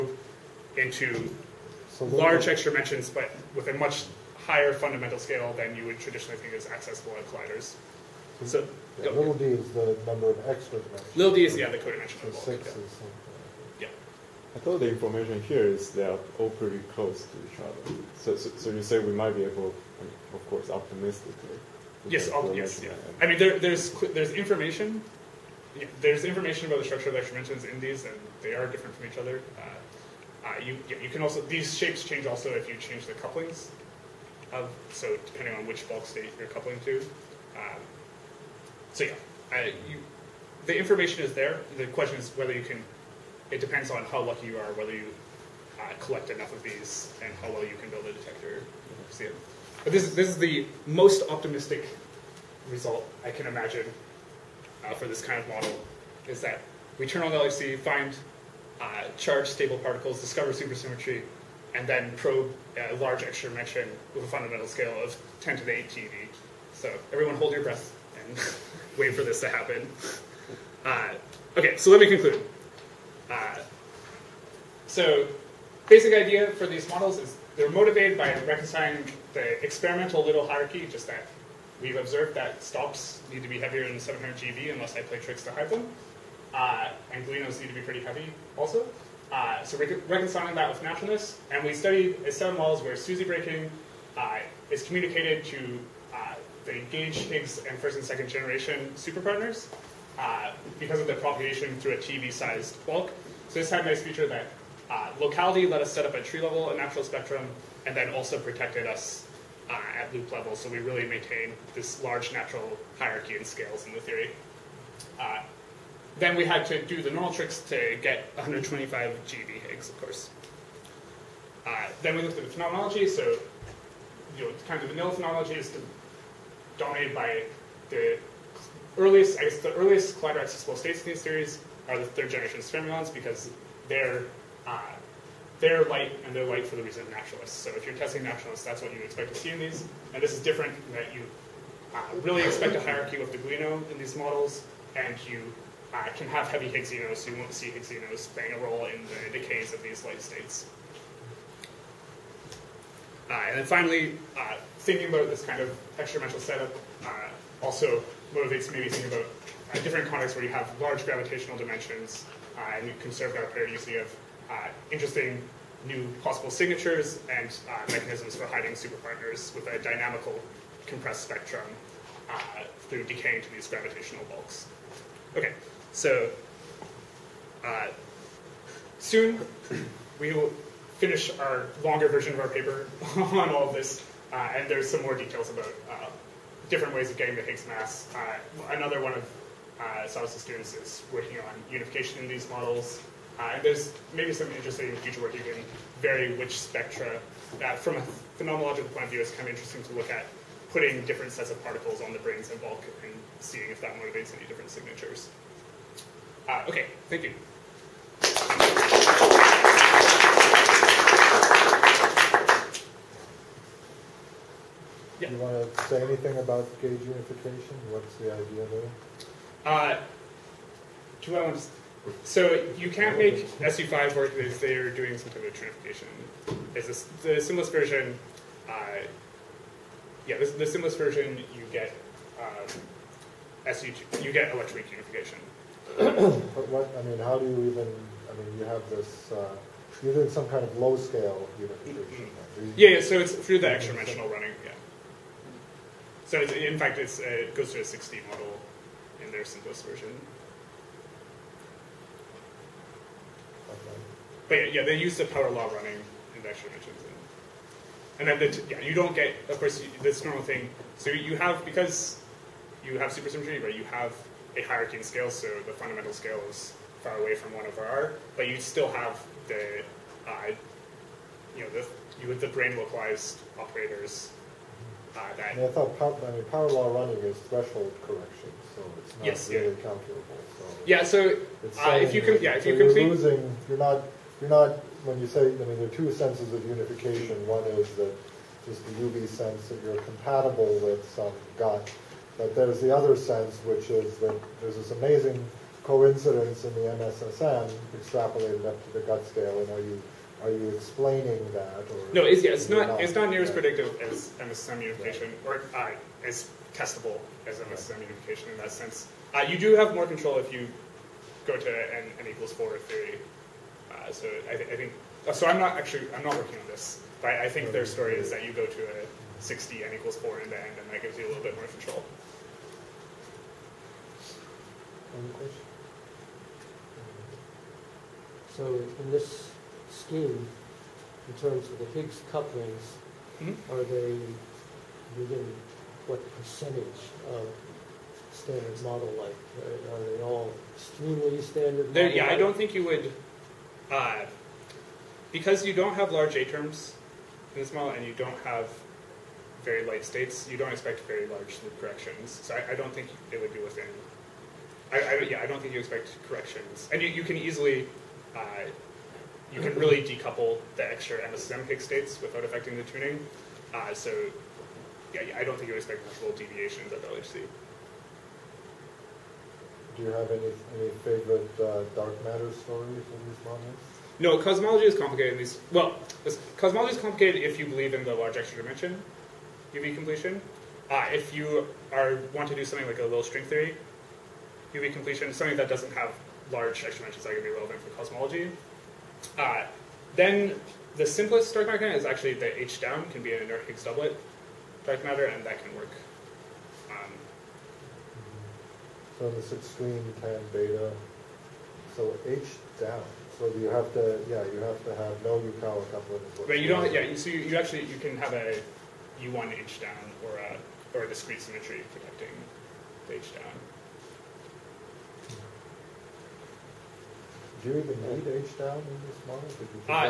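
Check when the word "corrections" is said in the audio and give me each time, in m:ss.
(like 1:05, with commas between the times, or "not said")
4:38, 5:51, 5:56.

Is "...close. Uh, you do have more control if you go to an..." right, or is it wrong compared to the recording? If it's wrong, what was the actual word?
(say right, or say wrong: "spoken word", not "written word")
wrong: "sense", not "close".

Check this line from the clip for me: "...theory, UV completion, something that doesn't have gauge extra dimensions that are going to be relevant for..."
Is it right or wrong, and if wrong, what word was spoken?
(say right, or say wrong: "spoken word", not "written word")
wrong: "large", not "gauge".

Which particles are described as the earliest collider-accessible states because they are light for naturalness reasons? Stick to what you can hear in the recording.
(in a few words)
third generation fermions.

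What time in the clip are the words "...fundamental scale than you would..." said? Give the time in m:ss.
0:04.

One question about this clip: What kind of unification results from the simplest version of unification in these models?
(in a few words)
electroweak unification.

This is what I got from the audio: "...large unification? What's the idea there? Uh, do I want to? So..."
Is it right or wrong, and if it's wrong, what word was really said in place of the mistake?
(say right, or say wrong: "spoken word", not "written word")
wrong: "gauge", not "large".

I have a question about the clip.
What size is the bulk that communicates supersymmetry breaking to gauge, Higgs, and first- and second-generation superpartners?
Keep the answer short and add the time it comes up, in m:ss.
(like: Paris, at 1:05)
TeV-sized, at 1:41.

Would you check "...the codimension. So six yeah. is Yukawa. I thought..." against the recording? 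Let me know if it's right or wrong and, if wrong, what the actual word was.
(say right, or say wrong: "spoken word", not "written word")
wrong: "Yeah", not "Yukawa".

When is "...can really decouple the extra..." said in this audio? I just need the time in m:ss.
5:59.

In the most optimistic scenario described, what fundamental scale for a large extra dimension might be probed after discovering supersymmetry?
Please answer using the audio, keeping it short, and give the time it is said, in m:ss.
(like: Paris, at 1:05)
10^8 GeV, at 1:05.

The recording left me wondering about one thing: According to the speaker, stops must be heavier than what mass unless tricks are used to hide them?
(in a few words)
700 GeV.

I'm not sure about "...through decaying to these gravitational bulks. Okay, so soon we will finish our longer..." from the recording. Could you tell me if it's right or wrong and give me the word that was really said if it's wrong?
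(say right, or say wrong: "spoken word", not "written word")
right.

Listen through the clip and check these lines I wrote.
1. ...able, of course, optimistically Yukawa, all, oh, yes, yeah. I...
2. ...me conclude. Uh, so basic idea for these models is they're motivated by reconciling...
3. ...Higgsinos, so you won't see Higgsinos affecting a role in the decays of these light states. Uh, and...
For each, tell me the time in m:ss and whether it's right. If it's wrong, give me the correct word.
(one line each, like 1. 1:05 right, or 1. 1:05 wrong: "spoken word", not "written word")
1. 0:19 wrong: "Yes", not "Yukawa"
2. 1:12 right
3. 2:26 wrong: "playing", not "affecting".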